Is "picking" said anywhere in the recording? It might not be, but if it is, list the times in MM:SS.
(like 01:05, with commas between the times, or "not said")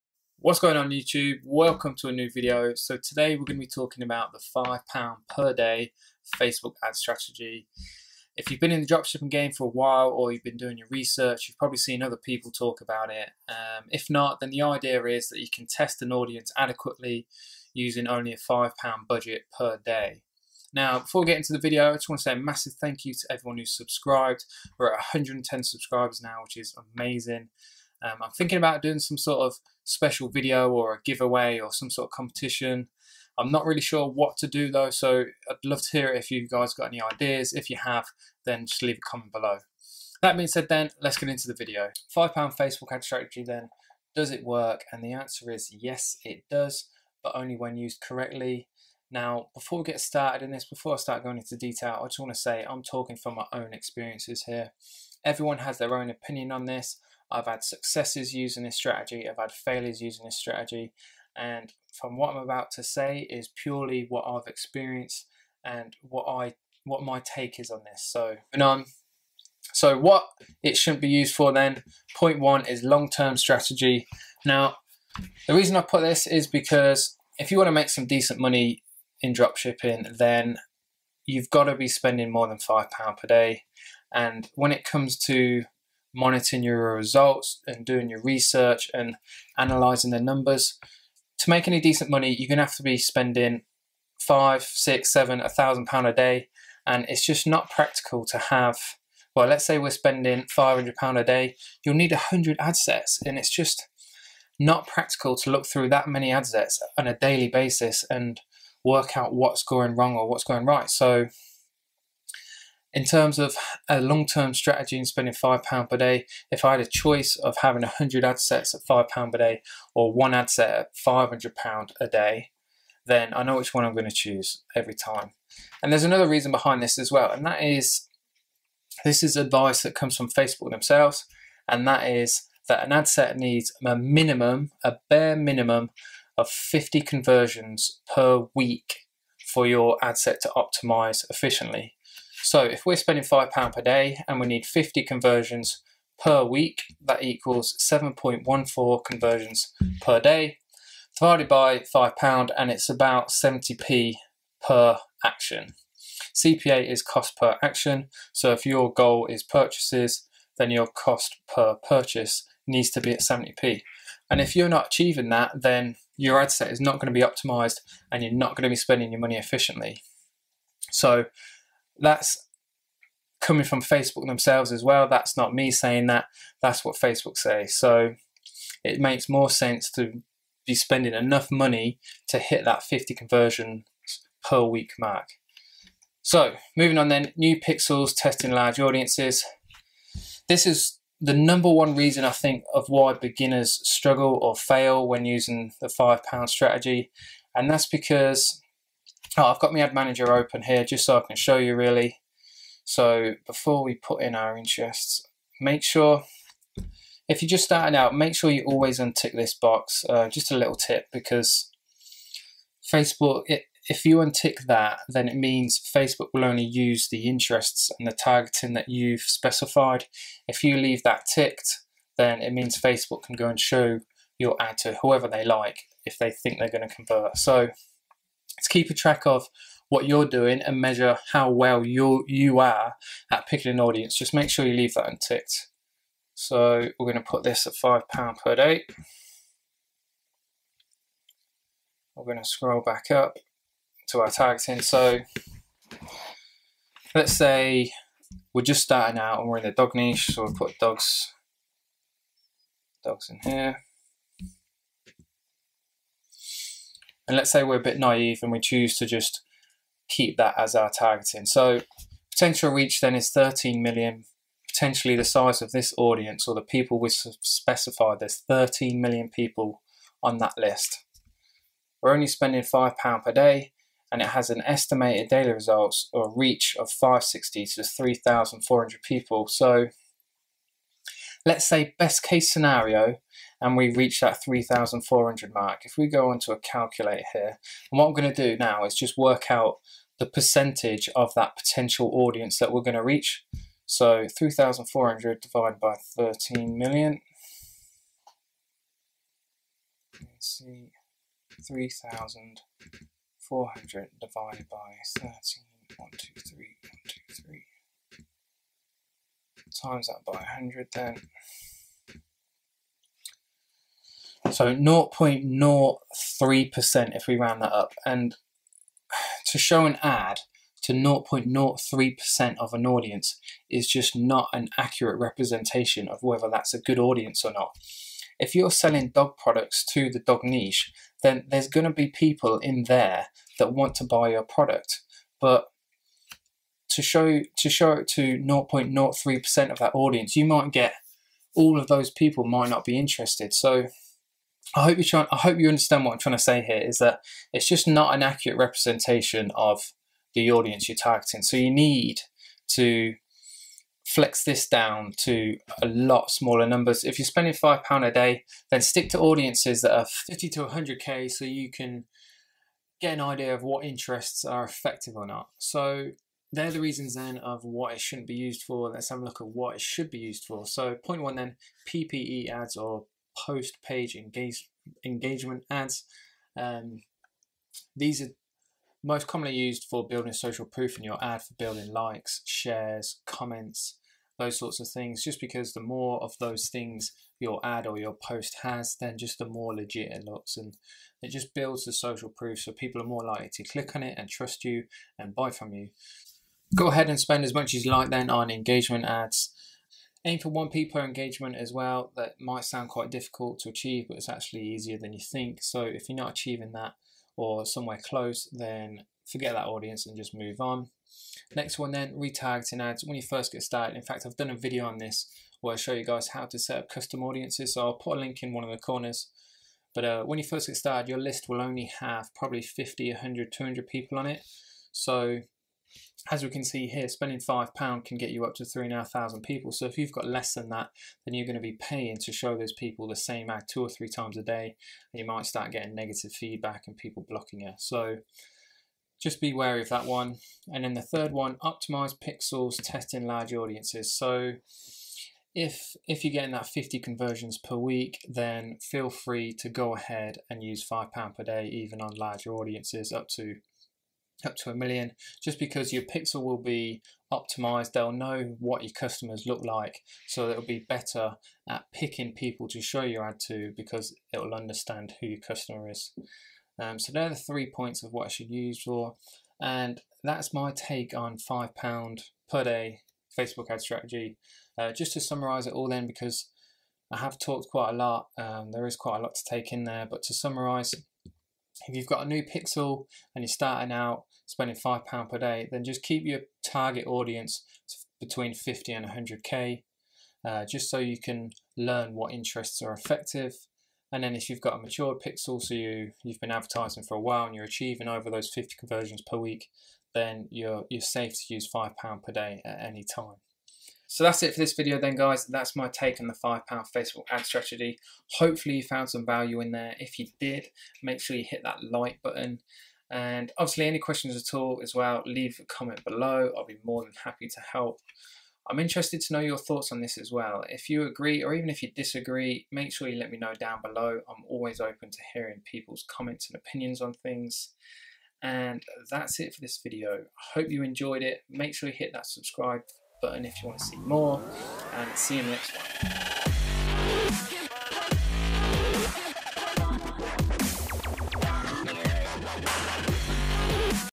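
03:53, 07:41.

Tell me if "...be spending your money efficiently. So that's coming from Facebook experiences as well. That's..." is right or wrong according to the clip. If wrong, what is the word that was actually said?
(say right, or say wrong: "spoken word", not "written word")
wrong: "themselves", not "experiences".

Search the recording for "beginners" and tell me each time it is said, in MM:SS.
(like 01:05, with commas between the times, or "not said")
03:13.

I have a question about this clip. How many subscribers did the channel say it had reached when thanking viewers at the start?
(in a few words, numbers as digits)
110.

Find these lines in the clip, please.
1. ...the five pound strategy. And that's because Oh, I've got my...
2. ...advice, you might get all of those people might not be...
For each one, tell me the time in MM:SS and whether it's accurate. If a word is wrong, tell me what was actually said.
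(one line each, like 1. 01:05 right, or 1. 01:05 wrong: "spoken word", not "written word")
1. 03:15 right
2. 05:39 wrong: "audience", not "advice".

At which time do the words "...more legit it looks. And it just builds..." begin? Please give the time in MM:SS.
06:29.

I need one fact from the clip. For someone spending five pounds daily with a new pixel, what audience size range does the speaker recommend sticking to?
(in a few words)
50 to 100k.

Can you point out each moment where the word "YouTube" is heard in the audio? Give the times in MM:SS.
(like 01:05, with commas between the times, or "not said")
00:00.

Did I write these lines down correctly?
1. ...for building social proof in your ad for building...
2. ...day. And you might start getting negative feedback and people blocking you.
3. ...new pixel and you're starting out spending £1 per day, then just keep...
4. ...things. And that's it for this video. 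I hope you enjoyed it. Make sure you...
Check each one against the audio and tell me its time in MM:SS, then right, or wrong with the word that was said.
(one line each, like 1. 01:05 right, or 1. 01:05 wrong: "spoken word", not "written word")
1. 06:19 right
2. 07:14 right
3. 08:02 wrong: "5", not "1"
4. 08:47 right.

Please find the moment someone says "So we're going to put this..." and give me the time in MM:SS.
03:56.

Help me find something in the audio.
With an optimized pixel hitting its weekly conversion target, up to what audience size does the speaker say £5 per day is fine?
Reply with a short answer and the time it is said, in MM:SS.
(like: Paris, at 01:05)
1 million, at 07:34.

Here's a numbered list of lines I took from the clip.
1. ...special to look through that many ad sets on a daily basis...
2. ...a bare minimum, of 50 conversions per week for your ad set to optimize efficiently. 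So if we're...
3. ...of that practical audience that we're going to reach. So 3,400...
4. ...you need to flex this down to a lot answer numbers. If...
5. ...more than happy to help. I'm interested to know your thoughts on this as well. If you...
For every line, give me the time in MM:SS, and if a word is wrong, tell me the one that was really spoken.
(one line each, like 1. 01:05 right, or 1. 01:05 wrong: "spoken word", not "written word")
1. 01:44 wrong: "practical", not "special"
2. 02:14 right
3. 04:51 wrong: "potential", not "practical"
4. 05:51 wrong: "smaller", not "answer"
5. 08:36 right.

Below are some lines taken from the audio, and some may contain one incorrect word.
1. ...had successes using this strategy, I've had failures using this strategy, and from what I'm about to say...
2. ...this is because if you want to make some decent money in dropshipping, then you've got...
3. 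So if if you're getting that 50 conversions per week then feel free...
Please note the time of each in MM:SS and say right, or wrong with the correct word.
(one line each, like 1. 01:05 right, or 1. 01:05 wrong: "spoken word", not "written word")
1. 00:57 right
2. 01:16 right
3. 07:24 right.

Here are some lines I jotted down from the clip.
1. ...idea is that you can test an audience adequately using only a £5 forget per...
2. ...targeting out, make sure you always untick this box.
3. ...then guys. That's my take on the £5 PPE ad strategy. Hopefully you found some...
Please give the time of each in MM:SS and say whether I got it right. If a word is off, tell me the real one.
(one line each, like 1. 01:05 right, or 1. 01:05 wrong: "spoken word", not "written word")
1. 00:14 wrong: "budget", not "forget"
2. 03:27 wrong: "starting", not "targeting"
3. 08:24 wrong: "Facebook", not "PPE".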